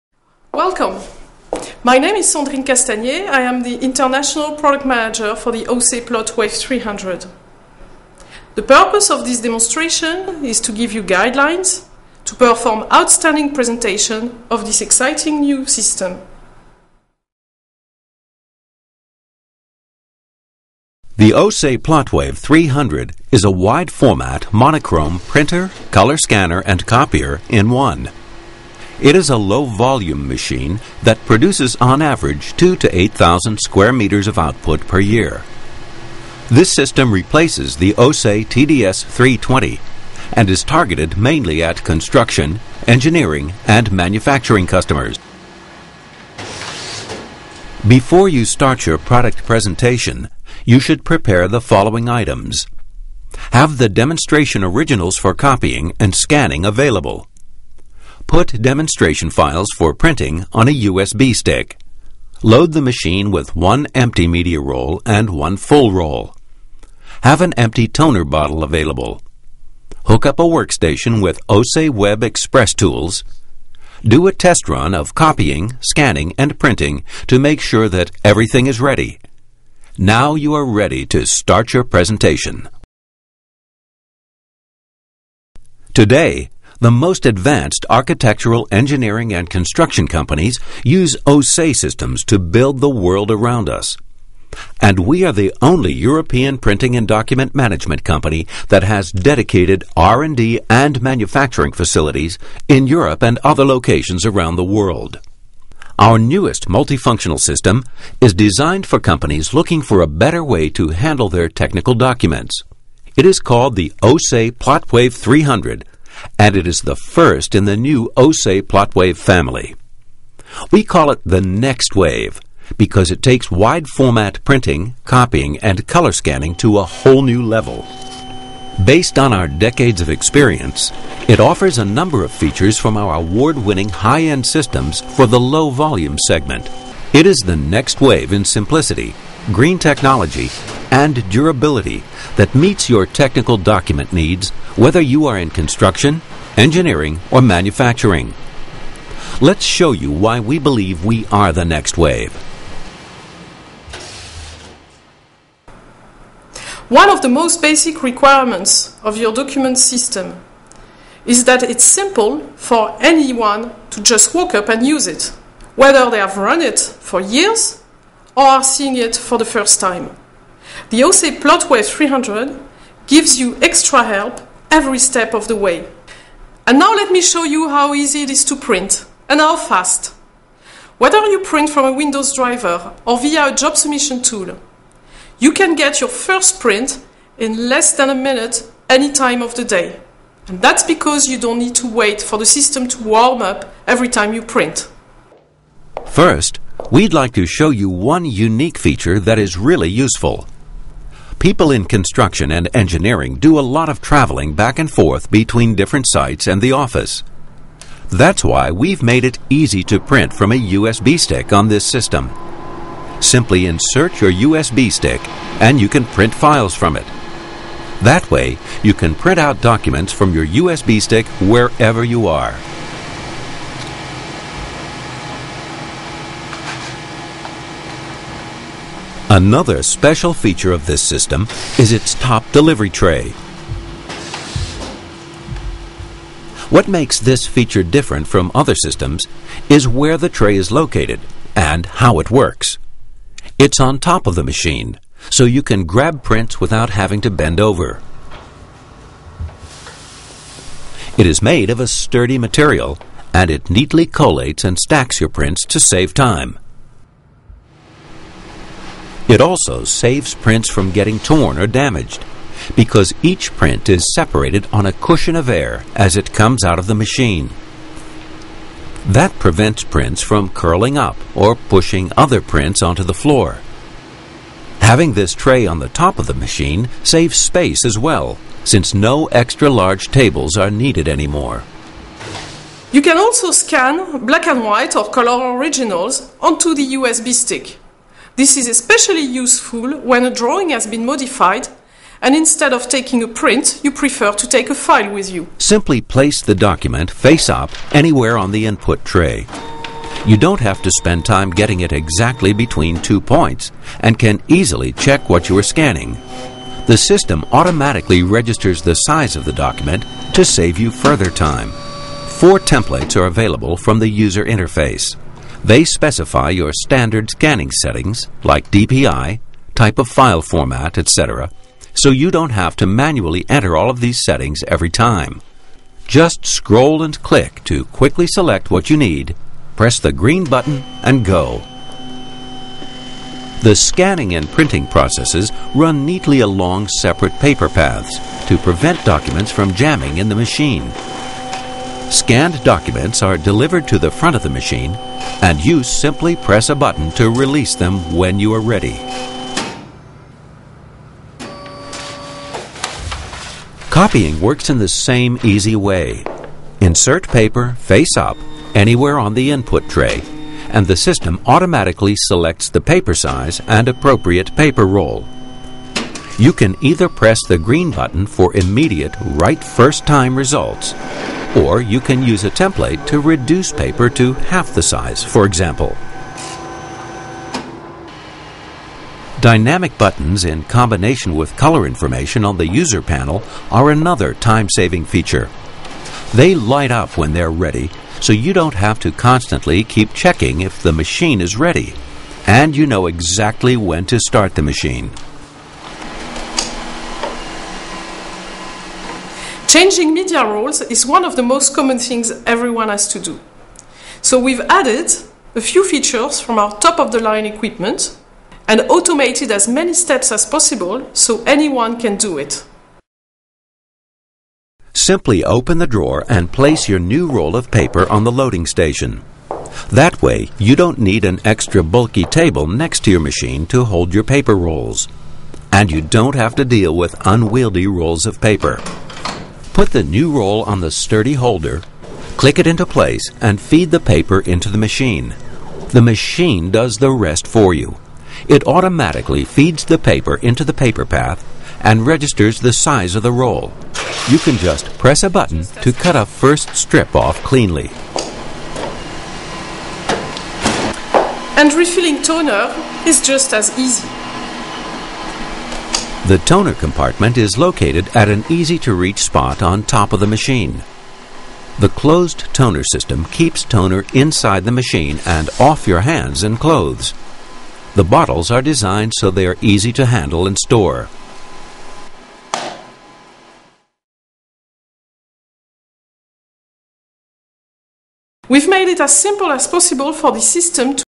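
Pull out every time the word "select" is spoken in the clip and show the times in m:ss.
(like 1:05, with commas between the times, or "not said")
5:28, 6:02.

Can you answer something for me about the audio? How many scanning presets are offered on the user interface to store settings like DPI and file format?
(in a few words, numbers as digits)
4.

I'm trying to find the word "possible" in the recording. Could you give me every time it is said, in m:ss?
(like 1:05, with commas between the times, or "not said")
6:50, 7:59.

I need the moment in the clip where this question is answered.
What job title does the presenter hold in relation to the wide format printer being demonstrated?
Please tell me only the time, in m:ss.
0:03.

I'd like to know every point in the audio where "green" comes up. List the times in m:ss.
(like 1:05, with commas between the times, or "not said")
2:19, 5:30, 6:07.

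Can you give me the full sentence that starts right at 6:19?
Dynamic buttons in combination with color information on the user panel are another time-saving feature.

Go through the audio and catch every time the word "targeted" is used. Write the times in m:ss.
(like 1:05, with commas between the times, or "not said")
0:40.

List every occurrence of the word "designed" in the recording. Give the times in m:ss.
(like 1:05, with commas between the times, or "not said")
1:48, 7:48.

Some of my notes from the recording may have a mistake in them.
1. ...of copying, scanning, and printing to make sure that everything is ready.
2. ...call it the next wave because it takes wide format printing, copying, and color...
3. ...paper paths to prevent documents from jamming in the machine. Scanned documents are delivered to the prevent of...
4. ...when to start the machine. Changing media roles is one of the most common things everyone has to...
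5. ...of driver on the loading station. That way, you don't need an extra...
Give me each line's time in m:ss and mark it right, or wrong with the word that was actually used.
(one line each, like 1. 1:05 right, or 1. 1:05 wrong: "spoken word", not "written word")
1. 1:14 right
2. 2:00 right
3. 5:37 wrong: "front", not "prevent"
4. 6:33 right
5. 6:57 wrong: "paper", not "driver".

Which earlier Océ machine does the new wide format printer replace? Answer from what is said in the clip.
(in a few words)
Océ TDS 320.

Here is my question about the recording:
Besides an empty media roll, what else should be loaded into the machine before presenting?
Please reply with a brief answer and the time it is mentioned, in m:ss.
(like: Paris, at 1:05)
one full roll, at 1:05.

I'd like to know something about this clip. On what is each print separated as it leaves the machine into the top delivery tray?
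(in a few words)
a cushion of air.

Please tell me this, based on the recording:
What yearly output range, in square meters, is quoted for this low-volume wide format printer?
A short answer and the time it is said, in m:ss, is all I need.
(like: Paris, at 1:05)
2 to 8,000 square meters, at 0:32.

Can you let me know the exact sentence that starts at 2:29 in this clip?
Let's show you why we believe we are the next wave.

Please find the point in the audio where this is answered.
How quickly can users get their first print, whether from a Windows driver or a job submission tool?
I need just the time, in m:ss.
3:07.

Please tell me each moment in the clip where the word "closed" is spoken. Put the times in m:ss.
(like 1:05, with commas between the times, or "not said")
7:41.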